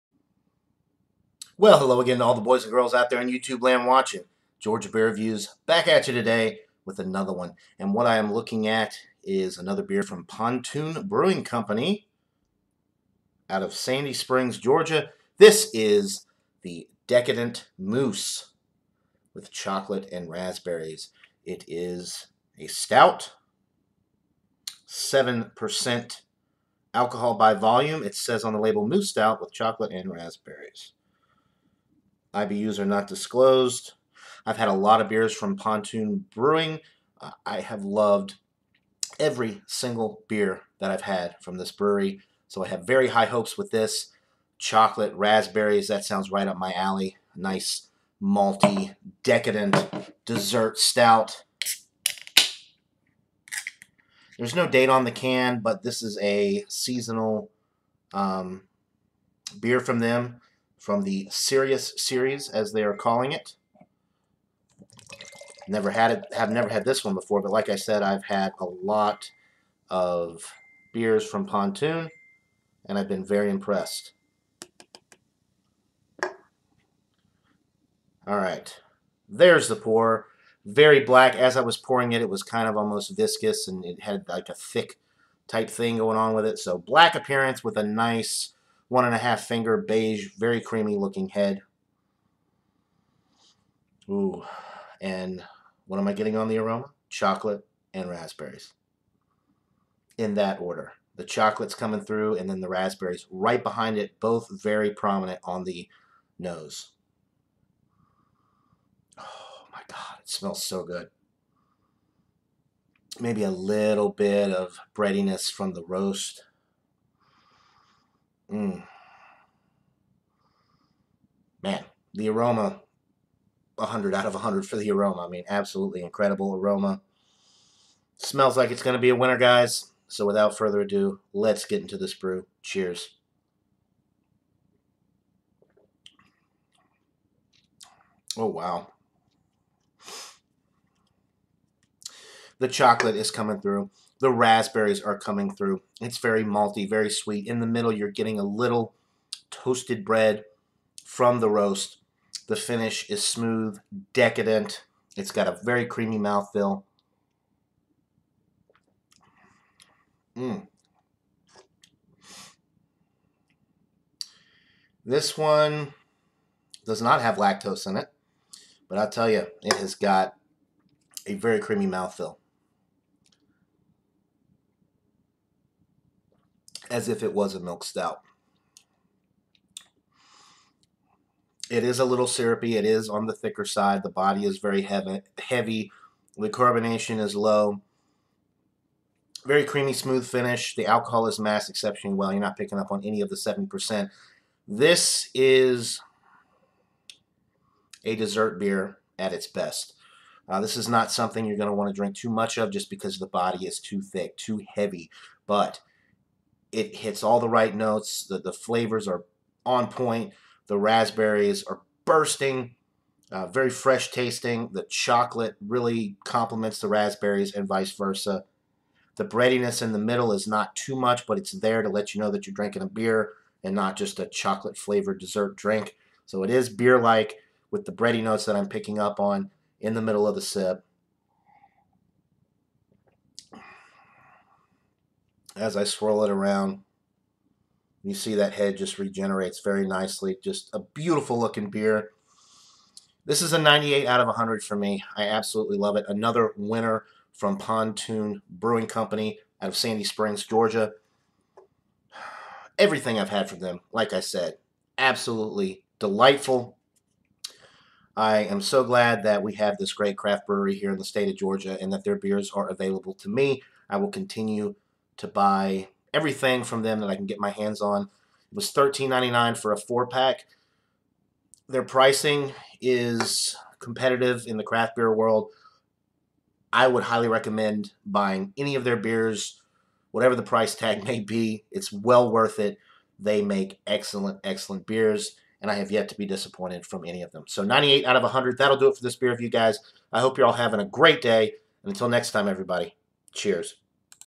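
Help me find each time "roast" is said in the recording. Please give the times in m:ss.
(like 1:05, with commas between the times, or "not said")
1:55, 2:31.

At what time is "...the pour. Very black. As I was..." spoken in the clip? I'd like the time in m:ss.
1:19.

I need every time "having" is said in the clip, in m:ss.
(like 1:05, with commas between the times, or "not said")
4:50.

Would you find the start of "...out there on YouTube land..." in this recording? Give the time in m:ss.
0:02.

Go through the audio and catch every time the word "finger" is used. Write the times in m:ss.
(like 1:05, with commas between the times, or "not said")
1:29.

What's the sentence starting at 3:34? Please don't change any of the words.
The chocolate really complements the raspberries and vice versa.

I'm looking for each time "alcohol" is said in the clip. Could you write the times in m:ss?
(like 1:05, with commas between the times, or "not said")
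0:26, 3:10.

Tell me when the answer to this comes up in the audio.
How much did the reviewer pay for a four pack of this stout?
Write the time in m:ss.
4:28.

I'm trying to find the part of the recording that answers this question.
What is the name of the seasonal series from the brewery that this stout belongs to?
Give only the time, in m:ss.
1:01.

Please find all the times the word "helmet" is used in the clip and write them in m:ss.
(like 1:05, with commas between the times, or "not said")
not said.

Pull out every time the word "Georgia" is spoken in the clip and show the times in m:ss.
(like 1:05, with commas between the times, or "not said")
0:04, 0:14, 4:10, 4:21.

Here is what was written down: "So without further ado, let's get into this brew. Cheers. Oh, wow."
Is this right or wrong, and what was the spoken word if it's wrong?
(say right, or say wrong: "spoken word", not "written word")
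right.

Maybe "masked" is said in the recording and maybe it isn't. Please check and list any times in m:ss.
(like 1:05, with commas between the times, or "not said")
3:11.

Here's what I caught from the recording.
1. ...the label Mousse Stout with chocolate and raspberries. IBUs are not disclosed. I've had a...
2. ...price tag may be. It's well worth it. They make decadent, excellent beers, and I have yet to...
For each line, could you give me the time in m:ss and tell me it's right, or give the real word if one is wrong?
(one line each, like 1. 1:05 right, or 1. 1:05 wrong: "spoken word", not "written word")
1. 0:28 right
2. 4:40 wrong: "excellent", not "decadent".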